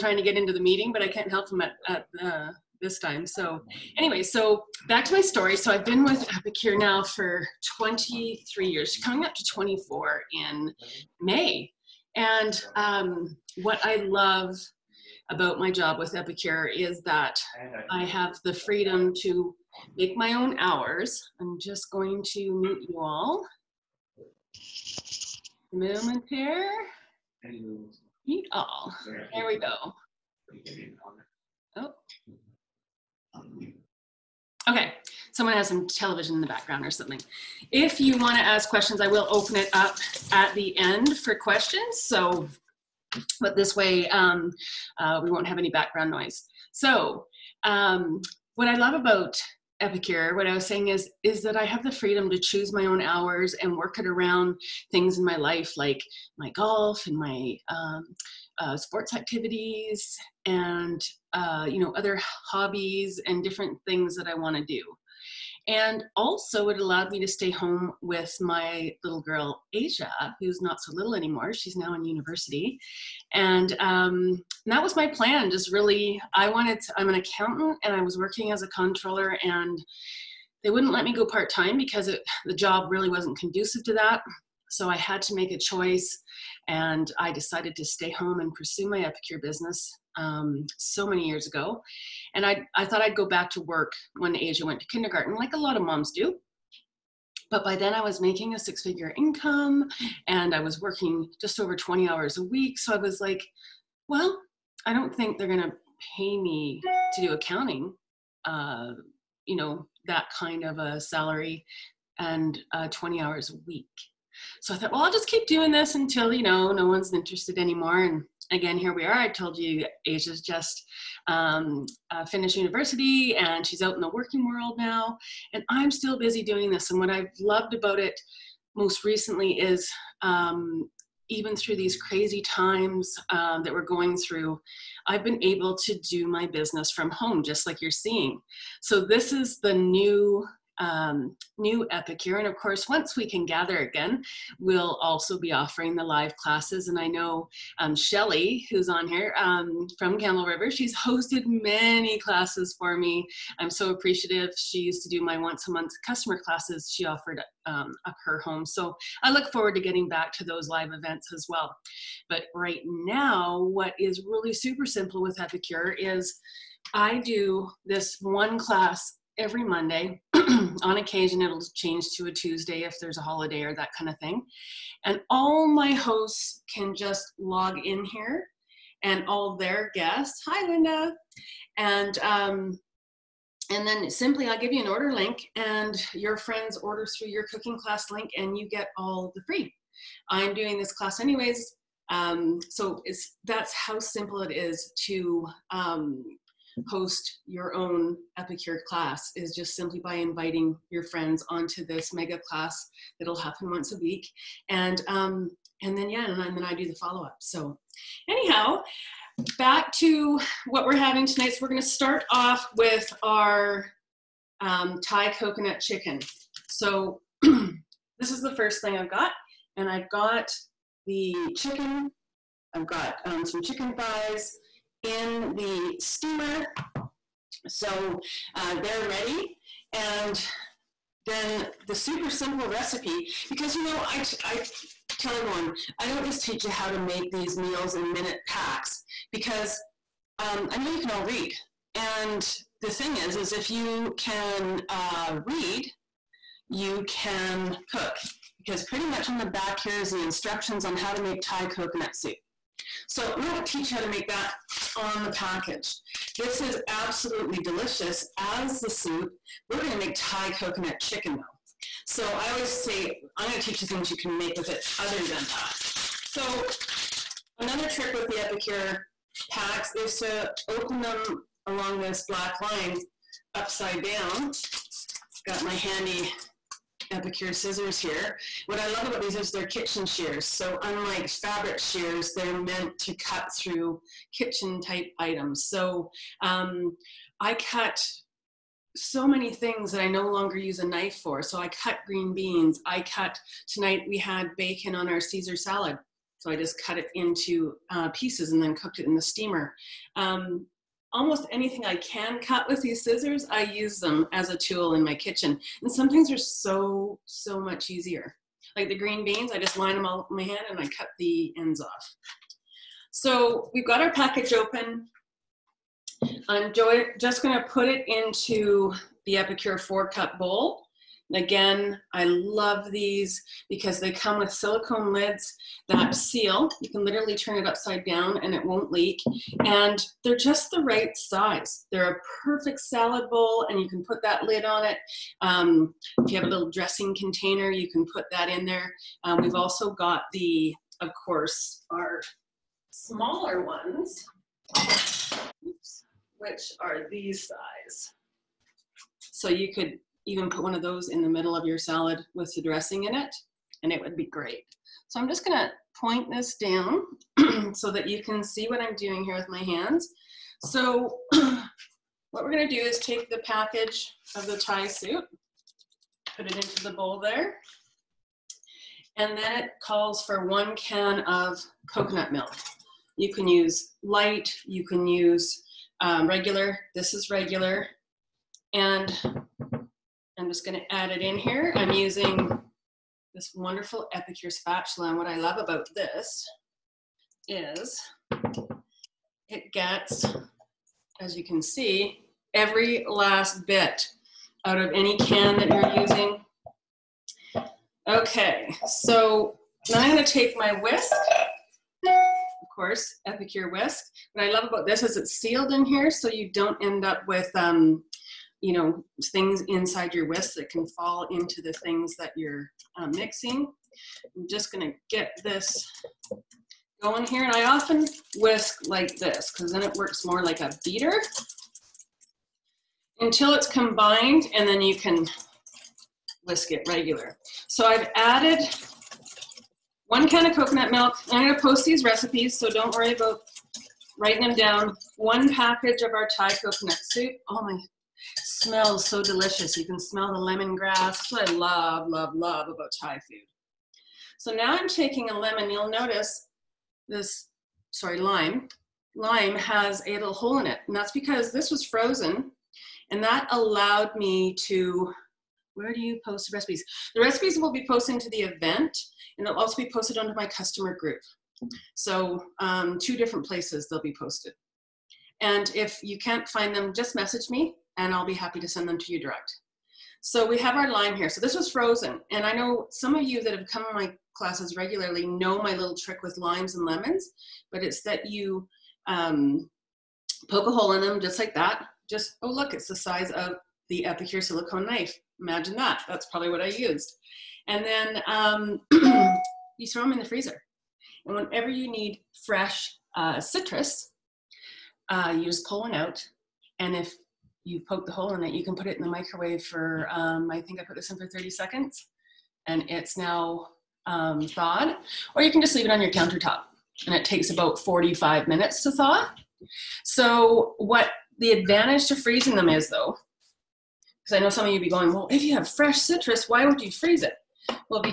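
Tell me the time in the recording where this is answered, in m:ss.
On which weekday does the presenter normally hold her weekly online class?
2:49.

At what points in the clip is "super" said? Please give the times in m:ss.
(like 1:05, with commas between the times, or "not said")
2:44, 3:51.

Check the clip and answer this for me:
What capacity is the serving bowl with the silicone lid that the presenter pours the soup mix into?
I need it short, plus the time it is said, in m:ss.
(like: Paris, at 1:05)
four cup, at 5:19.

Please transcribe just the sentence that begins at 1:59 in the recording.
I told you Asia's just um, uh, finished university and she's out in the working world now.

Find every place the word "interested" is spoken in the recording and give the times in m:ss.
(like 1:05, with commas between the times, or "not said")
1:57.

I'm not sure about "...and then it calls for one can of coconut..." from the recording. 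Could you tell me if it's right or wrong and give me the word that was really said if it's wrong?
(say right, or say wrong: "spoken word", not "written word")
right.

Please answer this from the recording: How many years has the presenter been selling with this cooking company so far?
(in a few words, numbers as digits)
23.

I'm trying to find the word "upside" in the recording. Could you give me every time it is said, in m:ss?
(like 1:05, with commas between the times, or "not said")
4:33, 5:27.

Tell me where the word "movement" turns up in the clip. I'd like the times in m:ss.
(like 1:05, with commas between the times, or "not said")
not said.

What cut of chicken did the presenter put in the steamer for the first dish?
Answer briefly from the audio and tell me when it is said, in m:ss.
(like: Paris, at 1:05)
thighs, at 3:43.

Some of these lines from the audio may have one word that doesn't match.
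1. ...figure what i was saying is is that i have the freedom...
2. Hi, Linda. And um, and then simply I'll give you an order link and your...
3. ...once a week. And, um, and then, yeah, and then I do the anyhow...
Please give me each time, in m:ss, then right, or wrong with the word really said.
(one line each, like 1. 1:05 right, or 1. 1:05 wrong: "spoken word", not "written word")
1. 0:49 wrong: "epicure", not "figure"
2. 3:00 right
3. 3:23 wrong: "follow", not "anyhow".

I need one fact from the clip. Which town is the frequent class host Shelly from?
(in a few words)
Campbell River.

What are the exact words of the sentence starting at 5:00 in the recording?
Um, almost anything I can cut with these scissors, I use them as a tool in my kitchen.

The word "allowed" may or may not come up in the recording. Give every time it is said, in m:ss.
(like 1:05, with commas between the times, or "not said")
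1:06, 7:33.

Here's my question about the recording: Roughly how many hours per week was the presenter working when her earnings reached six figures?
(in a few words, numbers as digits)
just over 20.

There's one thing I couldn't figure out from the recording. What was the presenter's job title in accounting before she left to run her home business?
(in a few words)
controller.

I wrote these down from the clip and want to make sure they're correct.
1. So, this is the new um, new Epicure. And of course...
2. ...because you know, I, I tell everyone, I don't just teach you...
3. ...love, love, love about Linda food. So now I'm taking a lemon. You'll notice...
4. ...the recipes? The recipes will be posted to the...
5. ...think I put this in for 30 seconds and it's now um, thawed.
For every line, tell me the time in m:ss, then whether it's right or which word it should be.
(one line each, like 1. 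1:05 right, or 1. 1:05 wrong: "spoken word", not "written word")
1. 2:18 right
2. 3:53 right
3. 7:21 wrong: "Thai", not "Linda"
4. 7:36 right
5. 8:20 right.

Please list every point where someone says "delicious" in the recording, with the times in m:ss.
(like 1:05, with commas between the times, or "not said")
4:17, 7:19.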